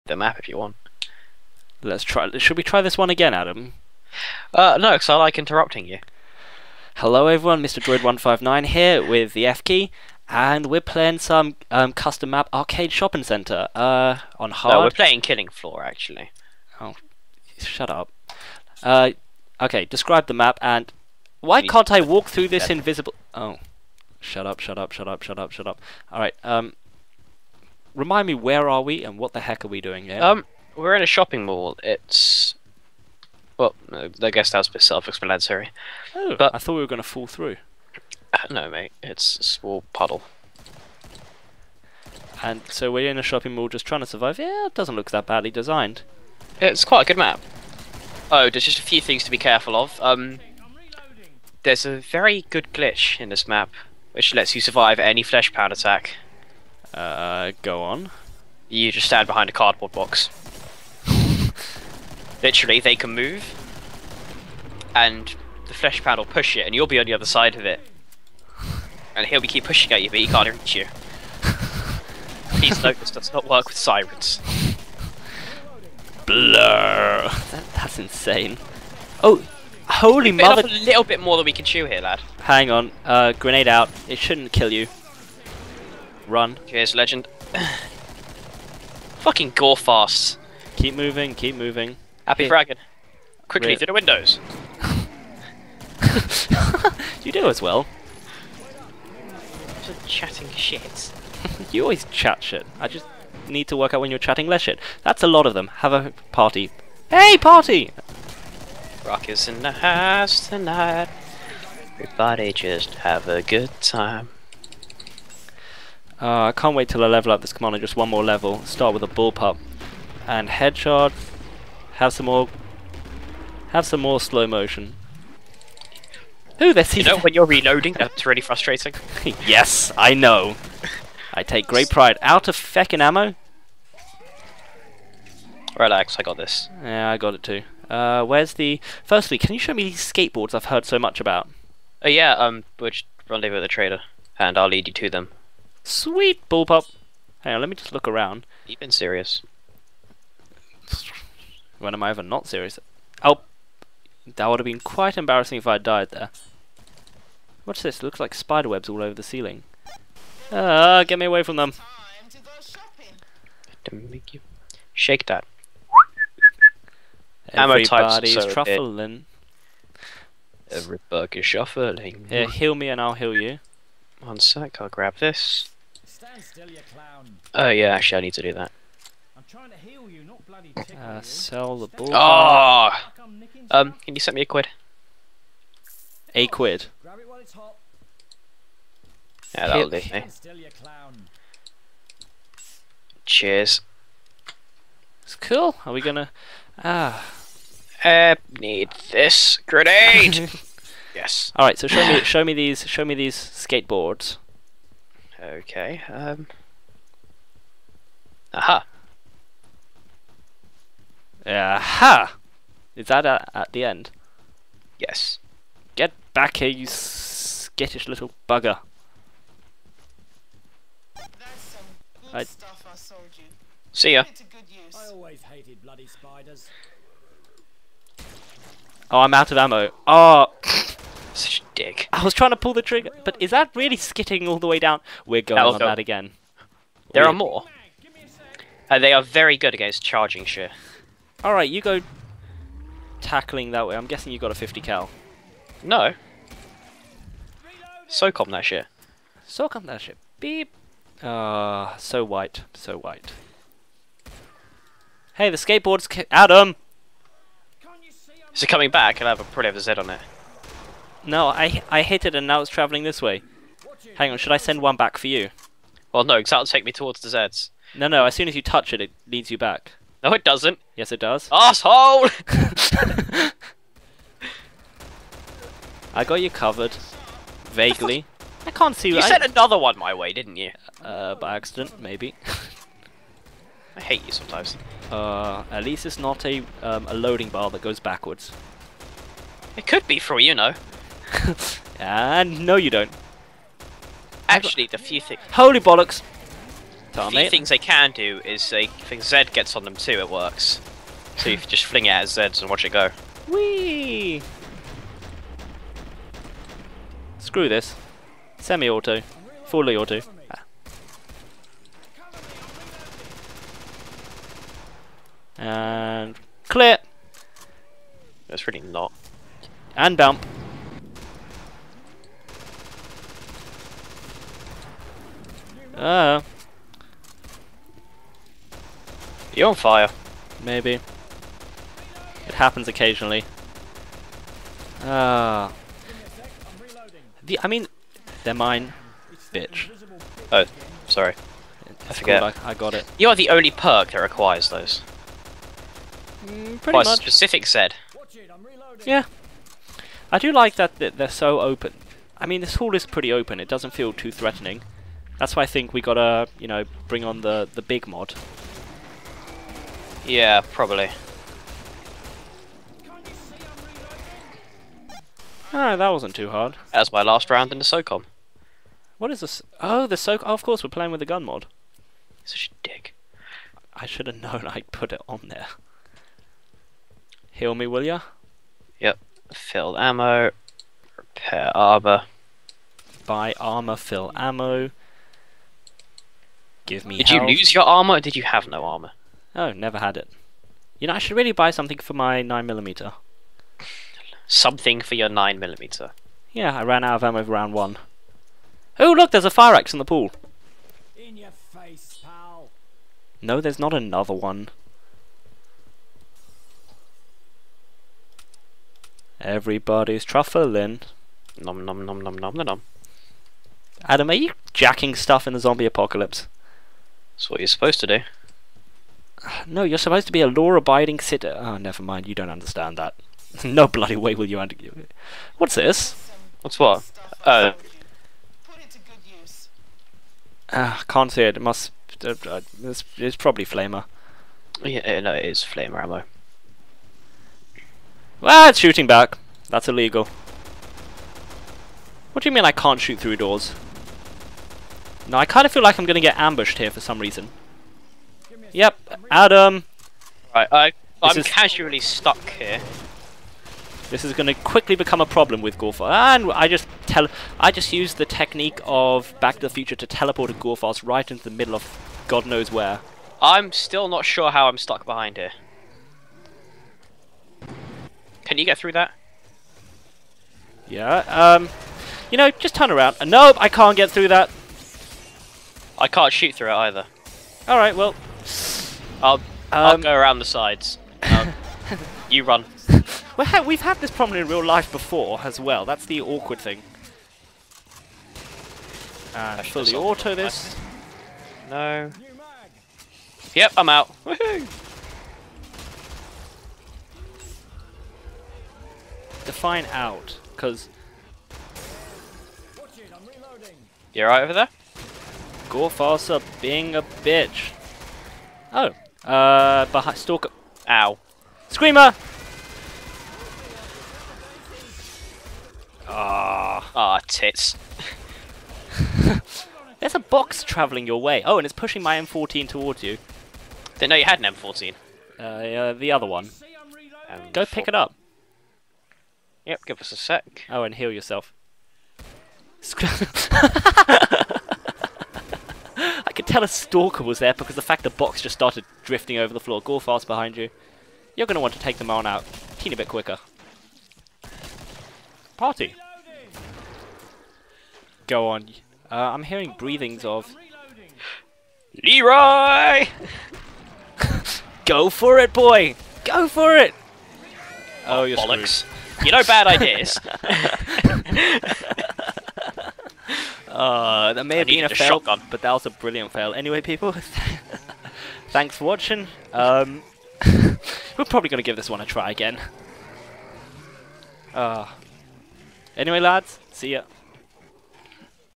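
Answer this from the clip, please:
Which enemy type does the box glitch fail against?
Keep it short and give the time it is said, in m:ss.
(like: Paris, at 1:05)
Sirens, at 1:13.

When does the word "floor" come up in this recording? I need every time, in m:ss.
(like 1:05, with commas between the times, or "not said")
0:15, 8:59.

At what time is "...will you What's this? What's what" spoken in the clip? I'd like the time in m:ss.
7:04.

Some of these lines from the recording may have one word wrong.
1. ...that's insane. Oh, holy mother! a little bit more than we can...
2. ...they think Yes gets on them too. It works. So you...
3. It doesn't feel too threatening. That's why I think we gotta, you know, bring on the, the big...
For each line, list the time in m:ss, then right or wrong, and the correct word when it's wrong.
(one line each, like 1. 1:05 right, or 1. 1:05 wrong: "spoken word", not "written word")
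1. 1:17 right
2. 4:58 wrong: "Zed", not "Yes"
3. 5:53 right.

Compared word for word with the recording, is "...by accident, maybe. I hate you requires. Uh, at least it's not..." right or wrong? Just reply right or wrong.
wrong.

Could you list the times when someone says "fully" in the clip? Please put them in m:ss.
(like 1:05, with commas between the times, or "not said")
5:09, 8:09.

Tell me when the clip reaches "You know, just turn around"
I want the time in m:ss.
7:52.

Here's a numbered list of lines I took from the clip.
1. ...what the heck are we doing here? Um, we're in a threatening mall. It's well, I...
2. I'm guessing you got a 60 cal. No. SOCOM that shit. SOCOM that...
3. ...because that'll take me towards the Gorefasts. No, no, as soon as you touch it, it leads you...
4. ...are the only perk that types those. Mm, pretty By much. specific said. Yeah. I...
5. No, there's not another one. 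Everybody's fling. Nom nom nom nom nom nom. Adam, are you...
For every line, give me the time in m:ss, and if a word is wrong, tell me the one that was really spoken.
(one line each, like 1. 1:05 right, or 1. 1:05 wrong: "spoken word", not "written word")
1. 0:29 wrong: "shopping", not "threatening"
2. 4:03 wrong: "50", not "60"
3. 4:26 wrong: "Zeds", not "Gorefasts"
4. 5:43 wrong: "requires", not "types"
5. 6:43 wrong: "truffling", not "fling".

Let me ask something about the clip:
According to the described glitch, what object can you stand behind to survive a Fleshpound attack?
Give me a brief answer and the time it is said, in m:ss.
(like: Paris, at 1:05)
Cardboard box, at 0:59.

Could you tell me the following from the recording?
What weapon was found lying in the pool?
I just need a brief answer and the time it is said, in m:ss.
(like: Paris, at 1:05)
Fire axe, at 6:39.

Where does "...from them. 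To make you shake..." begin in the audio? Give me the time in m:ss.
2:41.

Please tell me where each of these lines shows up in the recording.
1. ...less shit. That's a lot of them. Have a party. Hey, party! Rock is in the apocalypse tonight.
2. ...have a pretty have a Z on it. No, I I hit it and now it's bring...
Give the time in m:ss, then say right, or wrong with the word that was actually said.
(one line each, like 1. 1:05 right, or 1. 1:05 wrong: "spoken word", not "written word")
1. 1:44 wrong: "house", not "apocalypse"
2. 4:19 wrong: "travelling", not "bring".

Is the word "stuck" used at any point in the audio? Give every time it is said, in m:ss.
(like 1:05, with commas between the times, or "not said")
7:31, 7:44.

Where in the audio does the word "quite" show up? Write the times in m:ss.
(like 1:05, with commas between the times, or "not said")
0:46, 2:34.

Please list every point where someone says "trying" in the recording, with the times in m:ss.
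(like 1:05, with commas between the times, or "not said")
0:43, 3:52.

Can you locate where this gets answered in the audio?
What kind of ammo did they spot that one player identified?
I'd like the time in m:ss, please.
7:15.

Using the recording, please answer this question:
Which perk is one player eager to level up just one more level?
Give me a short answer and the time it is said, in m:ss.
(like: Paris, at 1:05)
Commando, at 1:57.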